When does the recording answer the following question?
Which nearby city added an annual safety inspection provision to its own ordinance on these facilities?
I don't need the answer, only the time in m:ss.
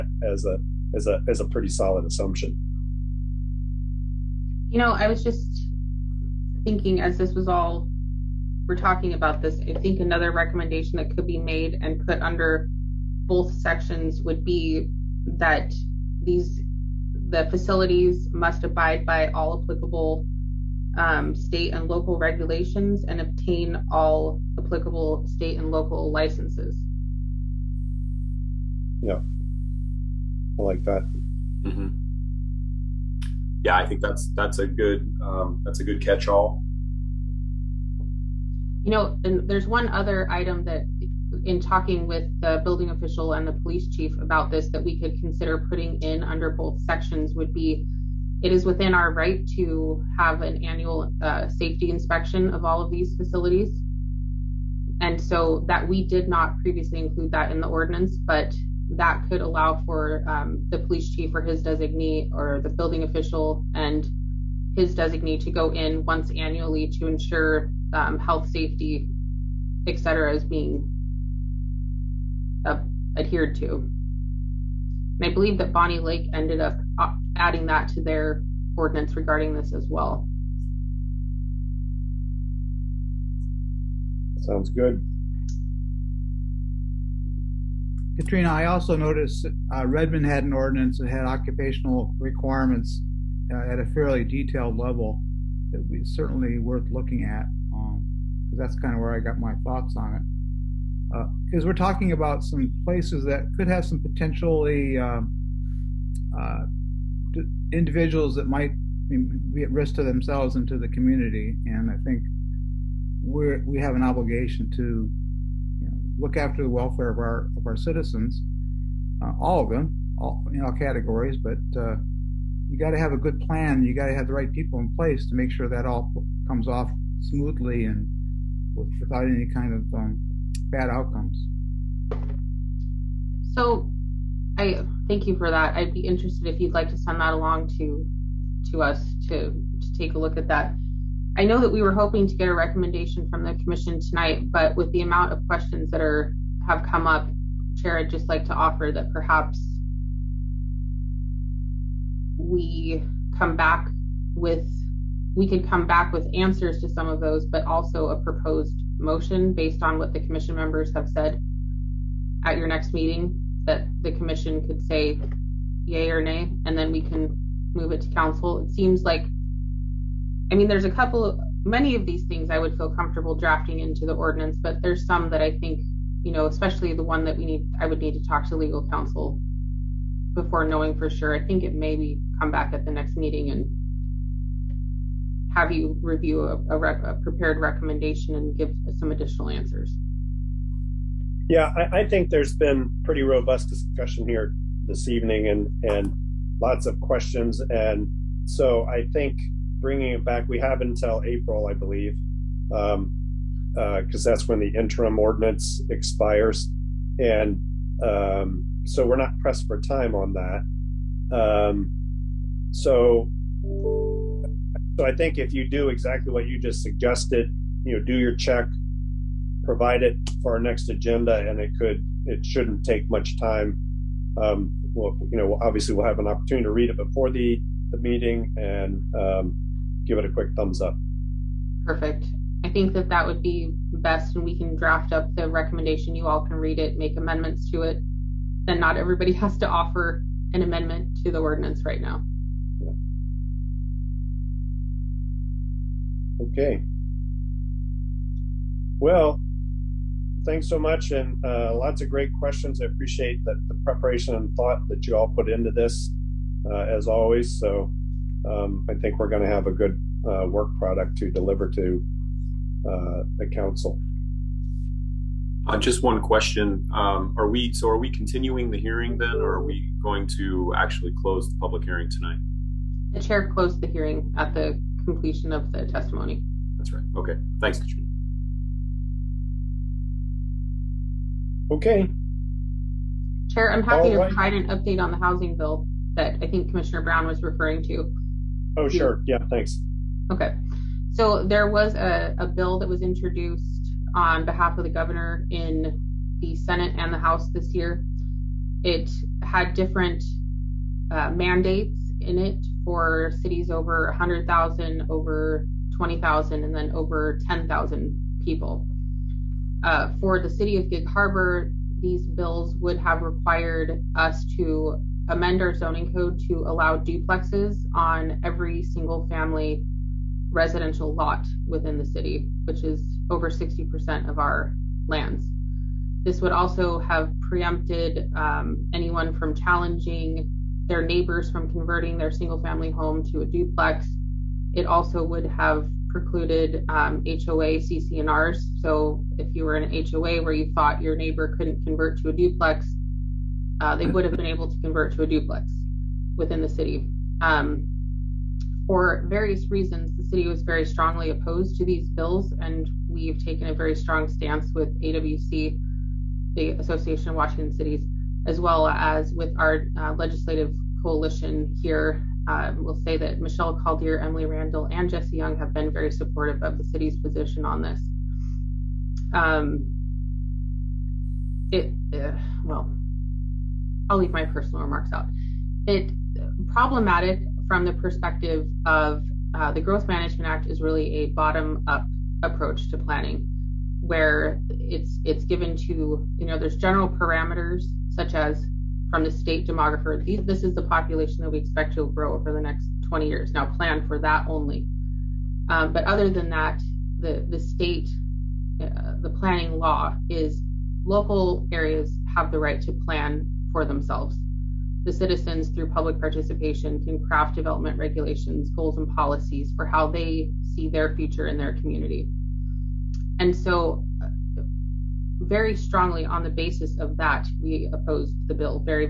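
1:15.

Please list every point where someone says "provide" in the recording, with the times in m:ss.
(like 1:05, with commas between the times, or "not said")
3:39, 4:44.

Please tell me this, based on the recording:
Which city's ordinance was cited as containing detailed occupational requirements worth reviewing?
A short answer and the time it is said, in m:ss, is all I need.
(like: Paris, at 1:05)
Redmond, at 1:29.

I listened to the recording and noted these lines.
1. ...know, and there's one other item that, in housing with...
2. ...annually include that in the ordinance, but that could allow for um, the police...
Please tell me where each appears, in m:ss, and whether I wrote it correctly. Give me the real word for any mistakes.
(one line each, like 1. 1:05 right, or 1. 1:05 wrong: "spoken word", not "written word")
1. 0:38 wrong: "talking", not "housing"
2. 0:56 wrong: "previously", not "annually".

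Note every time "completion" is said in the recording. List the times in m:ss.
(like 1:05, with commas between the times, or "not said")
4:35.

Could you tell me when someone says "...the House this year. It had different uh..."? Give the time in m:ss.
4:57.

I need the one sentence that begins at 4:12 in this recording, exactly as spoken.
I appreciate that the preparation and thought that you all put into this, uh, as always.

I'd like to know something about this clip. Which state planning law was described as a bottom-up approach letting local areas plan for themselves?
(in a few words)
Growth Management Act.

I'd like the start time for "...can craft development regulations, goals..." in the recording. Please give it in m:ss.
6:46.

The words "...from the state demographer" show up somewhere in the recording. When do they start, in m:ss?
6:29.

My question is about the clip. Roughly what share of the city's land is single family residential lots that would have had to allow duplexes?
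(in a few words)
over 60%.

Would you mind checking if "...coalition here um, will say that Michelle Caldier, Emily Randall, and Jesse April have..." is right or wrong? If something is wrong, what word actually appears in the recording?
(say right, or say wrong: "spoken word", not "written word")
wrong: "Young", not "April".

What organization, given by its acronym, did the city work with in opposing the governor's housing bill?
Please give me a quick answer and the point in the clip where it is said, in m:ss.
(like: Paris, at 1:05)
AWC, at 5:55.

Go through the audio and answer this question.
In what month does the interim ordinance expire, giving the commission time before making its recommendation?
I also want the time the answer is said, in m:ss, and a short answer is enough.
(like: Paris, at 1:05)
April, at 3:21.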